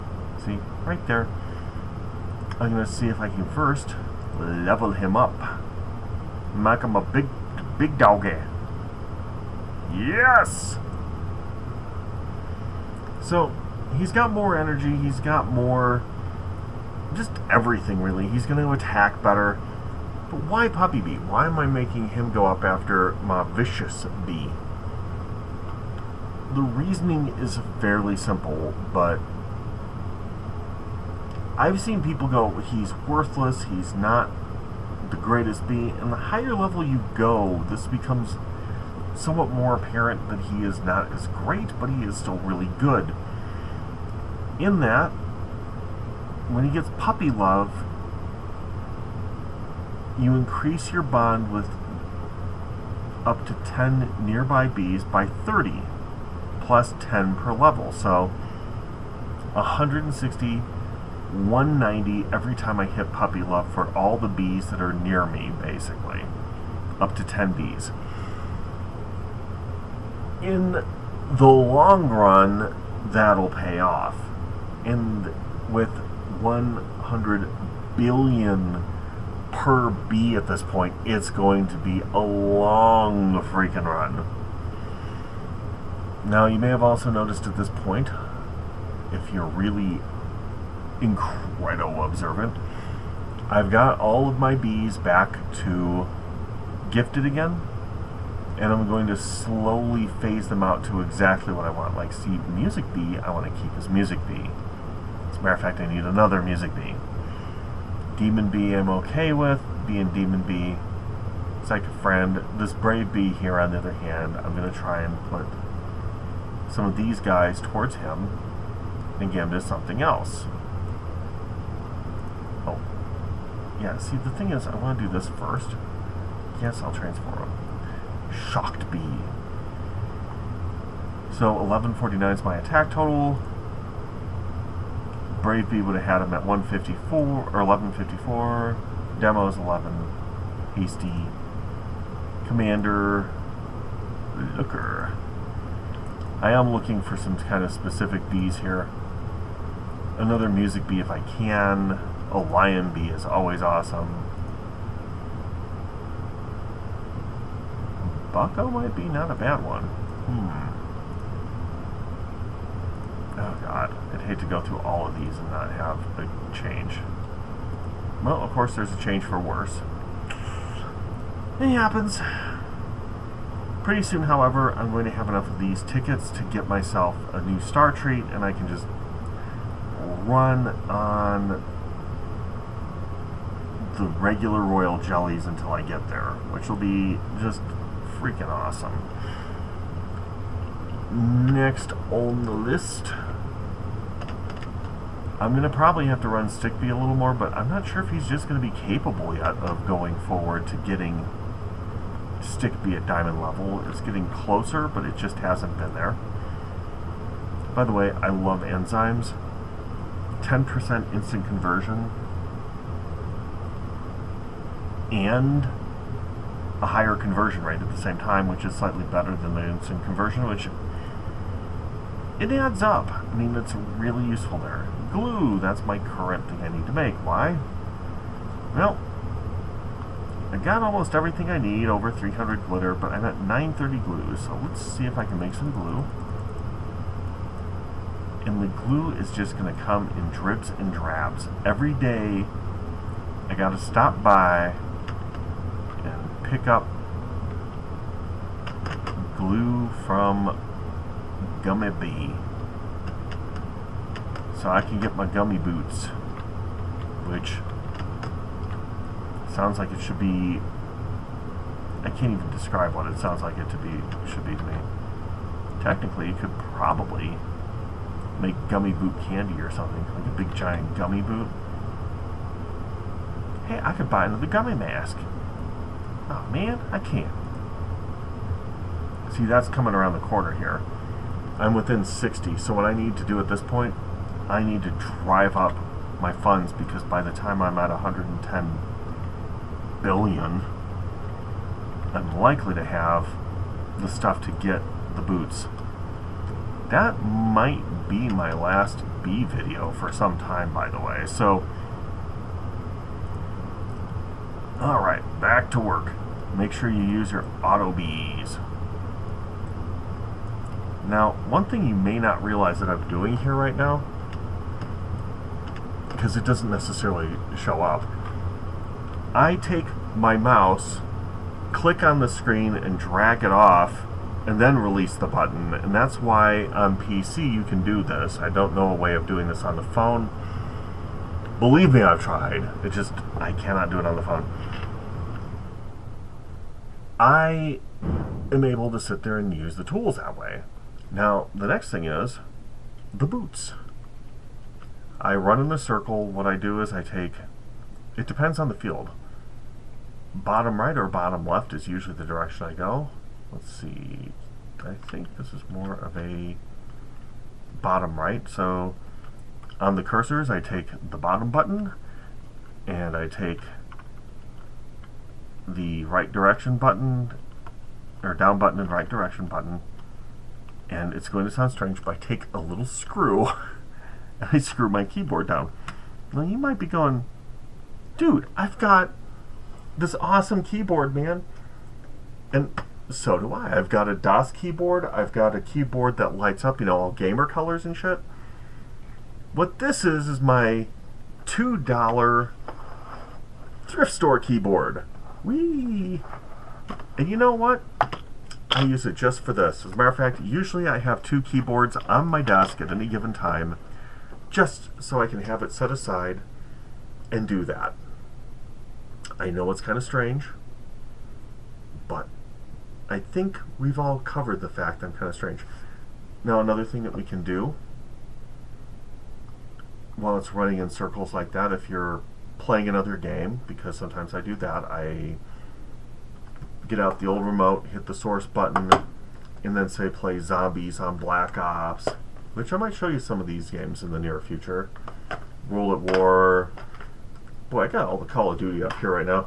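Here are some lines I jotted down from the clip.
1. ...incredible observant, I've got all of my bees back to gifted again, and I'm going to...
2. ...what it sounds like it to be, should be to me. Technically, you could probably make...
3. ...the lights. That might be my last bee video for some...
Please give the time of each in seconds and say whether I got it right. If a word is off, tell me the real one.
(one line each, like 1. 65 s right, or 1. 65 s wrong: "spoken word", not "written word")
1. 90 s right
2. 262 s right
3. 295 s wrong: "boots", not "lights".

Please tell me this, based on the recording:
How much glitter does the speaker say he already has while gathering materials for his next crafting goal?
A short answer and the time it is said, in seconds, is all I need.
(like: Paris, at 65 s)
over 300, at 231 s.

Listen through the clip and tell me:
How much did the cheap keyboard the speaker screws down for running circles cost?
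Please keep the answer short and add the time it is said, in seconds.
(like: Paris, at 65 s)
$2, at 391 s.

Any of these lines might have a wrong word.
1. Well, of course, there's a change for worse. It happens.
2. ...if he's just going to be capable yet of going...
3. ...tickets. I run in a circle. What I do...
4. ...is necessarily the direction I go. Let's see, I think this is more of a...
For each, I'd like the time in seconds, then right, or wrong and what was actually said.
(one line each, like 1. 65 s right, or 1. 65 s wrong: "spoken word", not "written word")
1. 168 s right
2. 198 s right
3. 343 s wrong: "boots", not "tickets"
4. 351 s wrong: "usually", not "necessarily".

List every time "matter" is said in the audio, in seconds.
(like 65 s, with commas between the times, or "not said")
105 s, 399 s.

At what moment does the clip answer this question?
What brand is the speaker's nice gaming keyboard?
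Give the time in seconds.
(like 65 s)
384 s.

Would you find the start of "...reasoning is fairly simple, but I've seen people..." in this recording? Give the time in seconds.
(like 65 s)
26 s.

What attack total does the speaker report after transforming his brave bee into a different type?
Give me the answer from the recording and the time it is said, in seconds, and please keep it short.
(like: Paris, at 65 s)
1149, at 131 s.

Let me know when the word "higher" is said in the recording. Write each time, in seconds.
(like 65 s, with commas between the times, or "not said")
36 s, 216 s.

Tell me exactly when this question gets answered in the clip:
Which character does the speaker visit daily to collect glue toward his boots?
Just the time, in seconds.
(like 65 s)
251 s.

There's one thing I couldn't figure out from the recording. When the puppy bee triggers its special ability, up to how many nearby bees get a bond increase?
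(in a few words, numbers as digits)
10.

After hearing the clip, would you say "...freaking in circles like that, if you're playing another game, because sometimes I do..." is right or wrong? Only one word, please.
wrong.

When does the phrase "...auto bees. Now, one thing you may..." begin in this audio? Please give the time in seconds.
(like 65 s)
307 s.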